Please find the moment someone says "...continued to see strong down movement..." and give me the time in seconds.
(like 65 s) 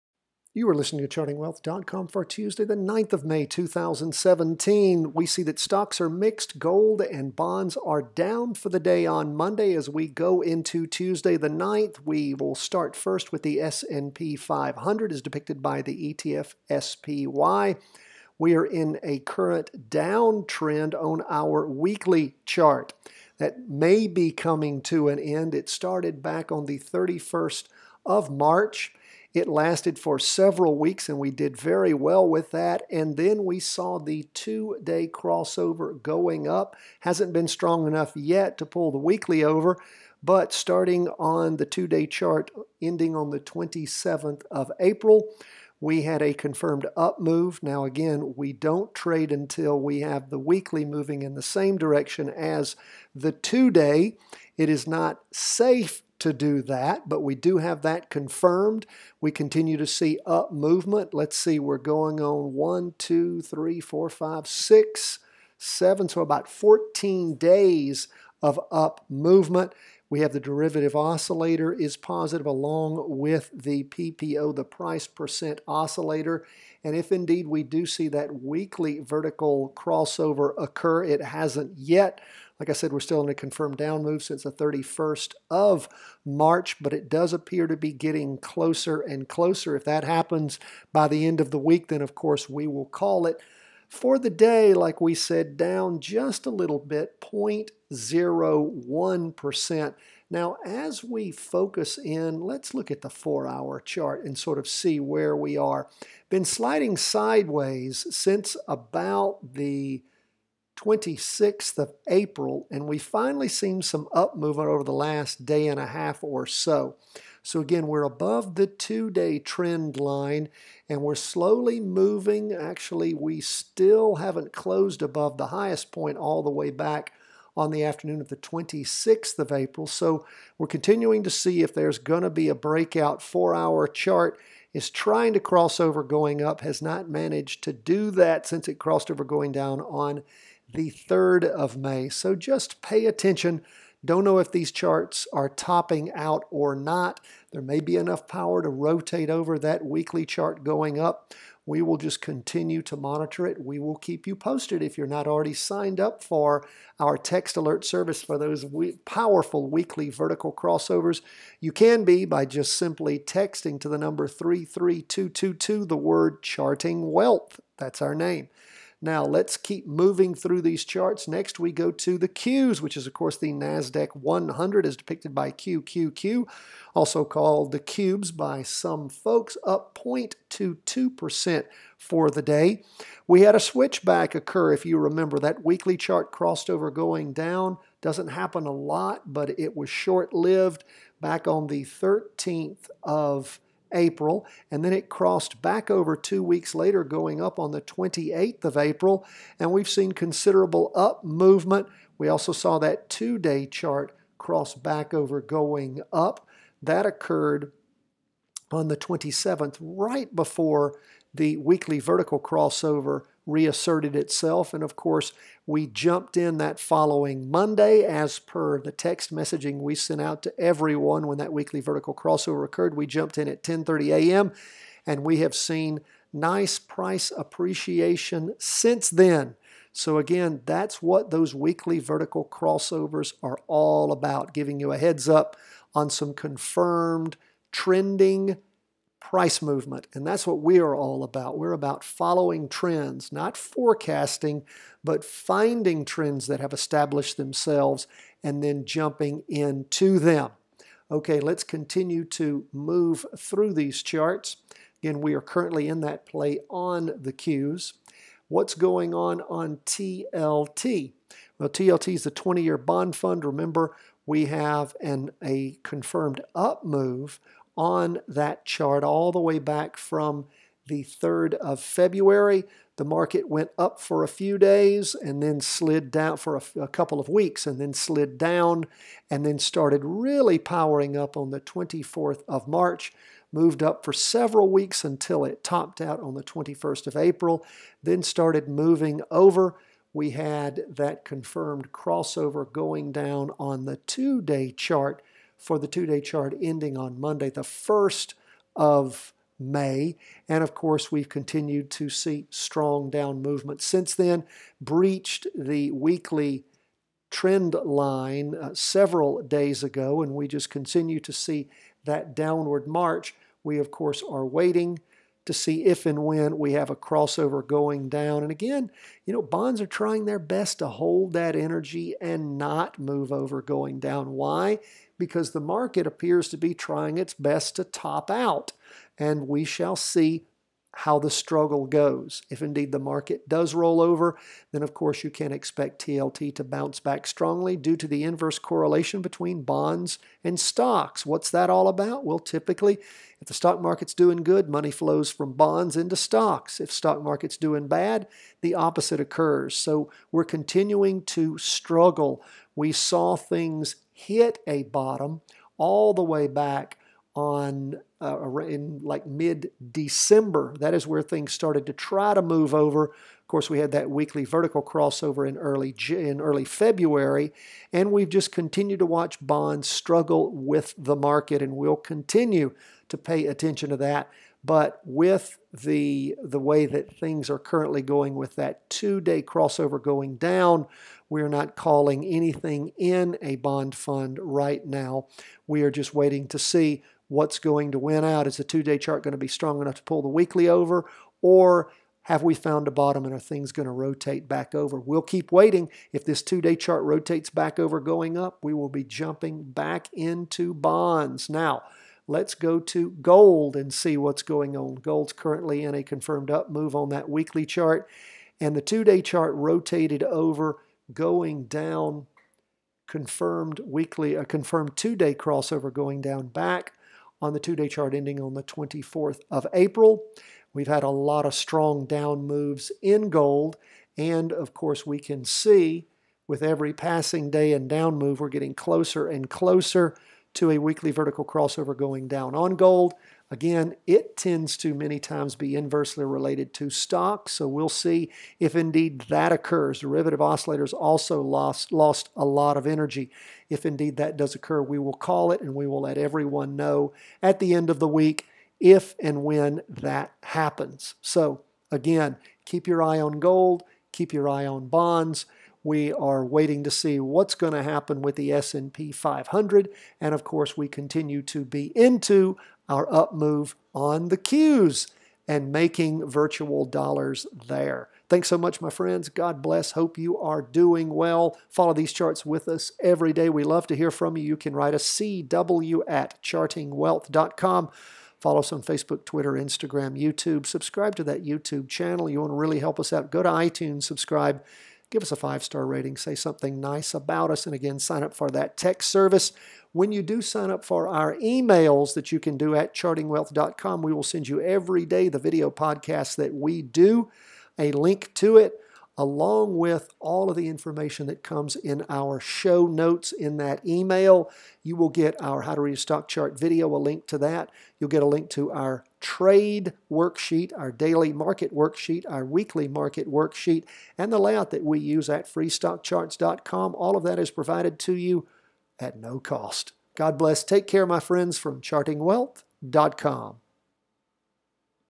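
301 s.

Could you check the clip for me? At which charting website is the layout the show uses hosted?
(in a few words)
freestockcharts.com.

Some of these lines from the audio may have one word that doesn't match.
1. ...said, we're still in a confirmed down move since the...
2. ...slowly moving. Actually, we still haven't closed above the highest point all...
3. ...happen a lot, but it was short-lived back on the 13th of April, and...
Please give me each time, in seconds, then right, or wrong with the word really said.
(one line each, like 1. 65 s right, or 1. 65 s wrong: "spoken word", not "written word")
1. 82 s right
2. 121 s right
3. 188 s right.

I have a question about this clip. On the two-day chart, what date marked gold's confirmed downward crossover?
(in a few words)
April 24.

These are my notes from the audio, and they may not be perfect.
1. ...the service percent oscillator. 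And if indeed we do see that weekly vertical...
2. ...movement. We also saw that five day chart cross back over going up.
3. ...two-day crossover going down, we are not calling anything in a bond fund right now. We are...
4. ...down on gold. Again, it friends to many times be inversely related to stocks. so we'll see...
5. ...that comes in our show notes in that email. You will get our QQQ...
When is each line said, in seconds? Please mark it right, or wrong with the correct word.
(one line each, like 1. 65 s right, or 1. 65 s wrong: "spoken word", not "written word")
1. 74 s wrong: "price", not "service"
2. 201 s wrong: "two", not "five"
3. 378 s right
4. 432 s wrong: "tends", not "friends"
5. 501 s wrong: "How", not "QQQ".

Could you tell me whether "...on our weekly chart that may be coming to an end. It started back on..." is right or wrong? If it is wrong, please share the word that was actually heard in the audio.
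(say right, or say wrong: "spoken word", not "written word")
right.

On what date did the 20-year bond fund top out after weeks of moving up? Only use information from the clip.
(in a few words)
April 21.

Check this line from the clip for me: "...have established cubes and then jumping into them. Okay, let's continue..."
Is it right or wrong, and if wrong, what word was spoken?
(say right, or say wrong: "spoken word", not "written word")
wrong: "themselves", not "cubes".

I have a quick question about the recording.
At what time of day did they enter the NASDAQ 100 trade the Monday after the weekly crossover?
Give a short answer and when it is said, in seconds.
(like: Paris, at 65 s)
10:30 a.m., at 223 s.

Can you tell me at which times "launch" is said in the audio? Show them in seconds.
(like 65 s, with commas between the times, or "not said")
not said.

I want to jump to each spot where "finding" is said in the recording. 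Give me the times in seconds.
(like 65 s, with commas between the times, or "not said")
245 s.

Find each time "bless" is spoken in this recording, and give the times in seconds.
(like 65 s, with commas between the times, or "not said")
469 s, 520 s.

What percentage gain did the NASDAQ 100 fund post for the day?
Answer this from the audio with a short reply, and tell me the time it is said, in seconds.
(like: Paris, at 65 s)
0.22%, at 180 s.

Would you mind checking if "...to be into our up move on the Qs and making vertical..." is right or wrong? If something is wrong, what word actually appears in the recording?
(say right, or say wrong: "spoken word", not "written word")
wrong: "virtual", not "vertical".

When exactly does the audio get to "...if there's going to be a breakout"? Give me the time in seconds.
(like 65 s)
131 s.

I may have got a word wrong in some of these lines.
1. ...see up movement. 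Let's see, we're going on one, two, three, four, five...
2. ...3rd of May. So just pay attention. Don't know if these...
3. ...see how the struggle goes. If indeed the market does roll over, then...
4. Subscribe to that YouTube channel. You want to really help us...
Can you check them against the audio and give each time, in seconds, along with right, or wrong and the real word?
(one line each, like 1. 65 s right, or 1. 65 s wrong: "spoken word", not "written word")
1. 59 s right
2. 140 s right
3. 329 s right
4. 480 s right.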